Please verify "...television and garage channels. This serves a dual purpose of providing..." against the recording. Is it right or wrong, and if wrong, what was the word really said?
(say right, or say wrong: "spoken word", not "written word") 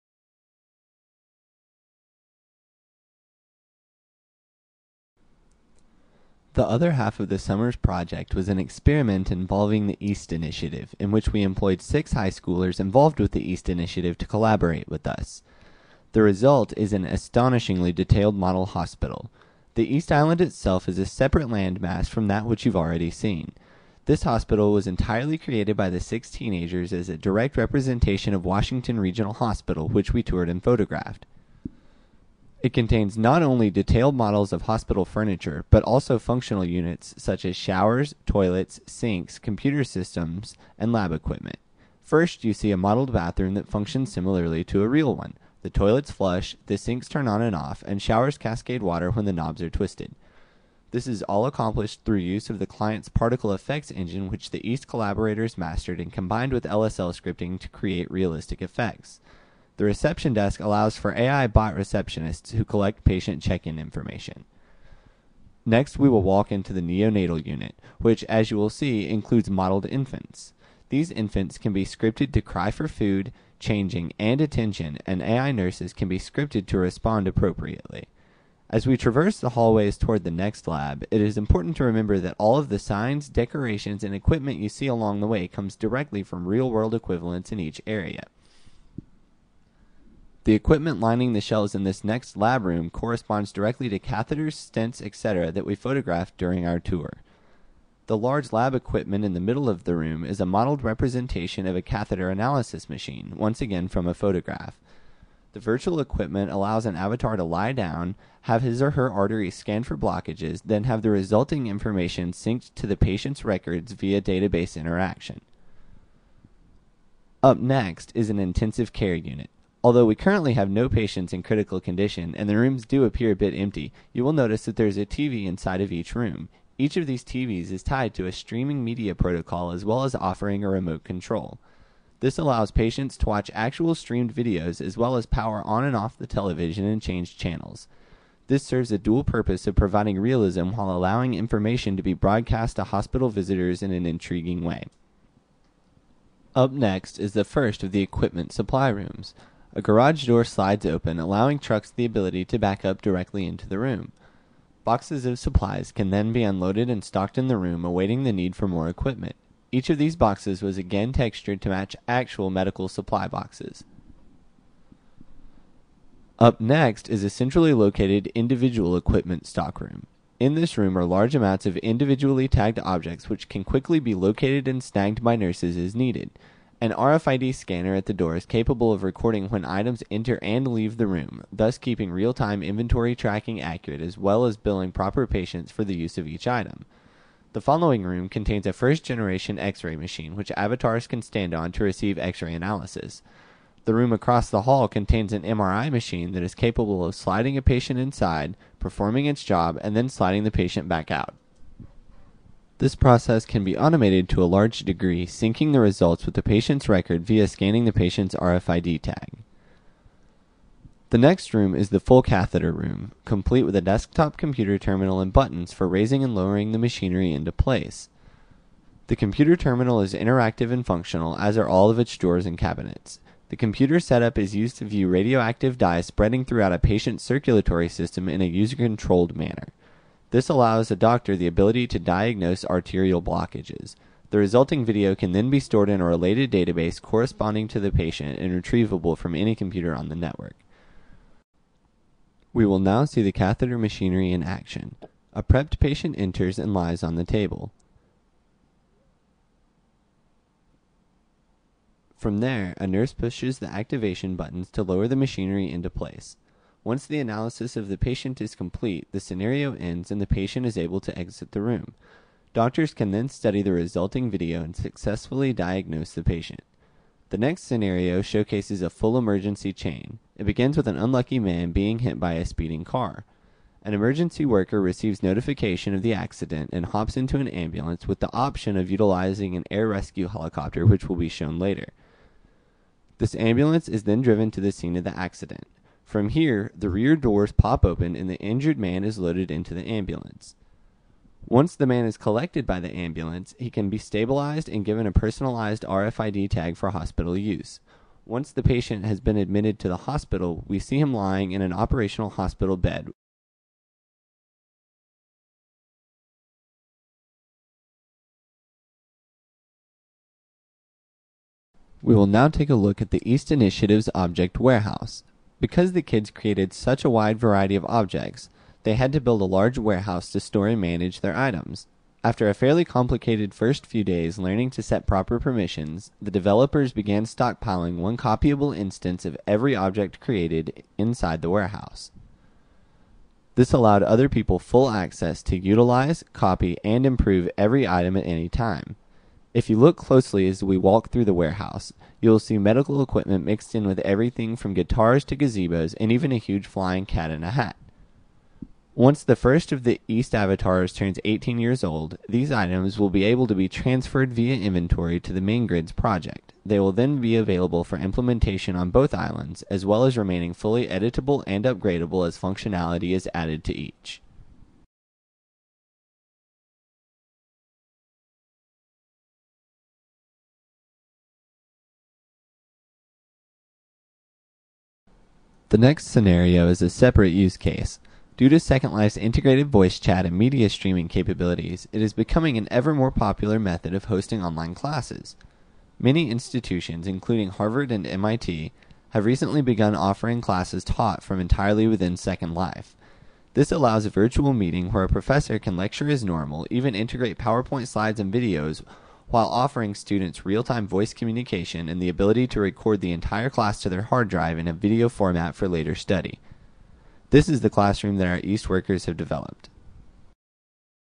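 wrong: "change", not "garage".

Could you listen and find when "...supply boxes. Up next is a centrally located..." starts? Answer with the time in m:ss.
2:42.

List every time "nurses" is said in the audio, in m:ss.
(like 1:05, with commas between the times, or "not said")
1:15, 2:55, 4:12.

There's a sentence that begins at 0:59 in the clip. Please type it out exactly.
The reception desk allows for AI bot receptionists who collect patient check in information.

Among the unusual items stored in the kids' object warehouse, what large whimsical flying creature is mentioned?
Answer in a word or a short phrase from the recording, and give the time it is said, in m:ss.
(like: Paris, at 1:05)
Cat in a hat, at 5:47.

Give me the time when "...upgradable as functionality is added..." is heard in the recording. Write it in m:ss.
6:01.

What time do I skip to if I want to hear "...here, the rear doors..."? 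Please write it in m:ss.
4:46.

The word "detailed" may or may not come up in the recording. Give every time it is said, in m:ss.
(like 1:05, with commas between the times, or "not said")
0:17, 0:33.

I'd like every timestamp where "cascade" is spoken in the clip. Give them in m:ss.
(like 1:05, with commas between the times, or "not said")
0:48.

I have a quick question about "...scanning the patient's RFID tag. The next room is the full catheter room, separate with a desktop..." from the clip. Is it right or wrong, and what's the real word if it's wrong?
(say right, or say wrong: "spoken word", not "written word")
wrong: "complete", not "separate".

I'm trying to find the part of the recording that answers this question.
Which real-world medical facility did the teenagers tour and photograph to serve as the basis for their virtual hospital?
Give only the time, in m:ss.
0:28.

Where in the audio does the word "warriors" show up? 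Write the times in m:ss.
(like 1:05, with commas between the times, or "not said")
not said.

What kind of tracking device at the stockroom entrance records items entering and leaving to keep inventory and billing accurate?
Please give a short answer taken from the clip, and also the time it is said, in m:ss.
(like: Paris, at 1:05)
RFID scanner, at 2:56.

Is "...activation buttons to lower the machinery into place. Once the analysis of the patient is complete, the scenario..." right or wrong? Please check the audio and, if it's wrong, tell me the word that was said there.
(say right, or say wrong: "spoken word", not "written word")
right.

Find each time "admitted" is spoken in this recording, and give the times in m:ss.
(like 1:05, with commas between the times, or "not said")
4:59.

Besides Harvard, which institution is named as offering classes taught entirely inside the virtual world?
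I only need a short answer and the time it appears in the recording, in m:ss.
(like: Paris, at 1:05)
MIT, at 6:28.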